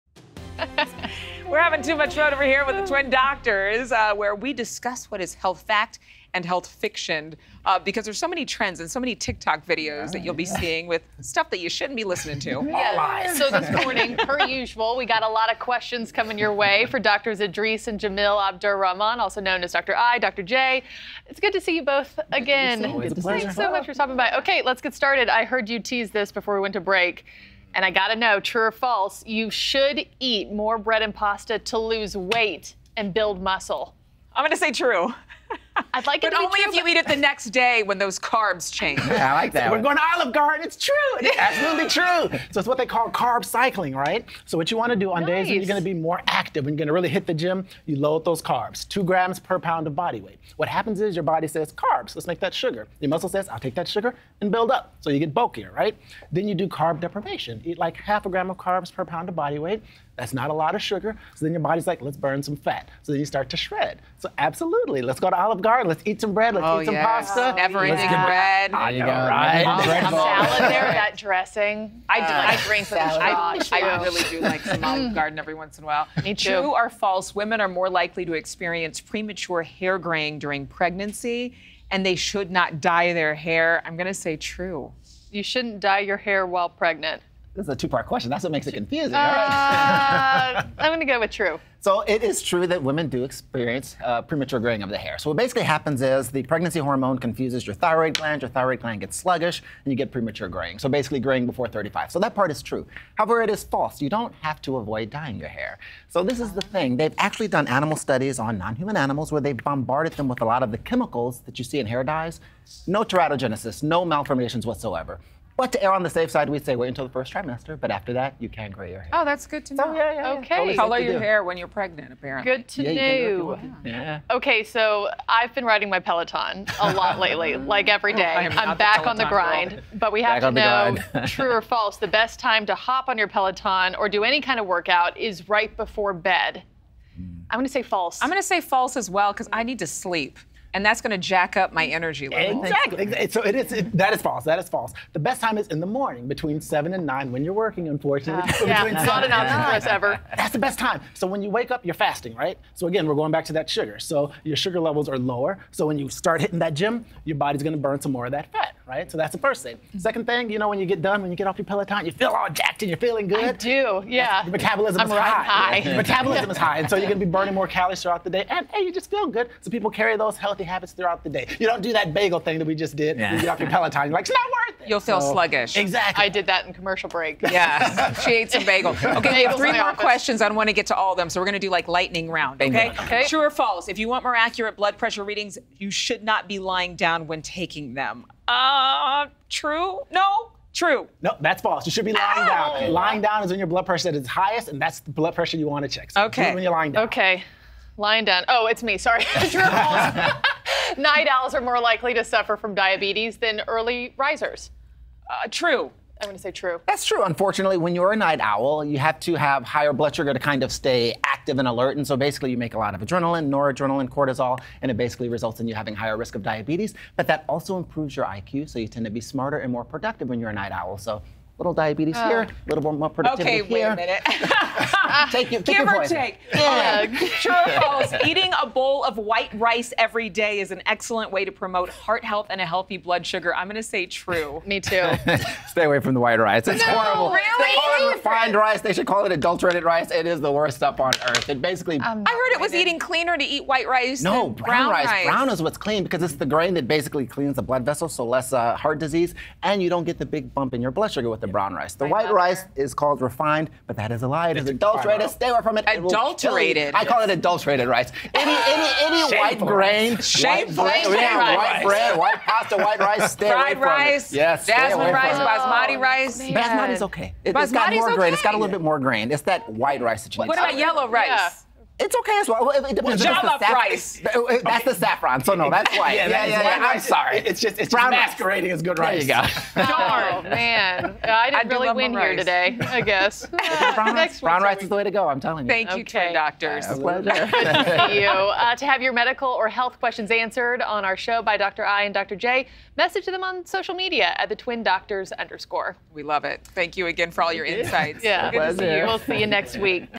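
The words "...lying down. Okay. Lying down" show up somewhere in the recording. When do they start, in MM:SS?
03:16.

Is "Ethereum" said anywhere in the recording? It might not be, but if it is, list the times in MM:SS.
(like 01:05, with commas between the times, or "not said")
not said.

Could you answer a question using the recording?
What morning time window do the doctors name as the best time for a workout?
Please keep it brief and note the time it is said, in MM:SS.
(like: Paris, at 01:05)
7 to 9, at 02:26.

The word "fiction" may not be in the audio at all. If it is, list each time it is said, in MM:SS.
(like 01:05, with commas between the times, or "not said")
00:06.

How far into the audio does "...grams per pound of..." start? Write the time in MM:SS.
00:49.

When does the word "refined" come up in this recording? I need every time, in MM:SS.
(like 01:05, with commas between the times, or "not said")
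03:58, 04:13.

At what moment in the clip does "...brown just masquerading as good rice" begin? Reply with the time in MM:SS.
04:37.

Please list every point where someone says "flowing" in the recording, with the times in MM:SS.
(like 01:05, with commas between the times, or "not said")
not said.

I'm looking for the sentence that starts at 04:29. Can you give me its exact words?
It's that white rice that you like.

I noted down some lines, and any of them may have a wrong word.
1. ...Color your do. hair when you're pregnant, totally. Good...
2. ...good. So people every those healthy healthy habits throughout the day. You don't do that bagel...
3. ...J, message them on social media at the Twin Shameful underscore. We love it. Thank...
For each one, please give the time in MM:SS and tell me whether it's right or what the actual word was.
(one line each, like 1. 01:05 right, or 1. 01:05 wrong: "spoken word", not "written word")
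1. 02:00 wrong: "apparently", not "totally"
2. 02:49 wrong: "carry", not "every"
3. 04:52 wrong: "Doctors", not "Shameful".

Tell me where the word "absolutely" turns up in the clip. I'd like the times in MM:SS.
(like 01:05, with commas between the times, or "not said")
00:41, 01:04.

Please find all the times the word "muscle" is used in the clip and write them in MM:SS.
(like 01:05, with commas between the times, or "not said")
00:33, 00:53.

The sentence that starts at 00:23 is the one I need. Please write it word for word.
Thanks so much for stopping by.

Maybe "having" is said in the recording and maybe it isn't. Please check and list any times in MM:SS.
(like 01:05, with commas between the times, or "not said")
00:01, 03:35.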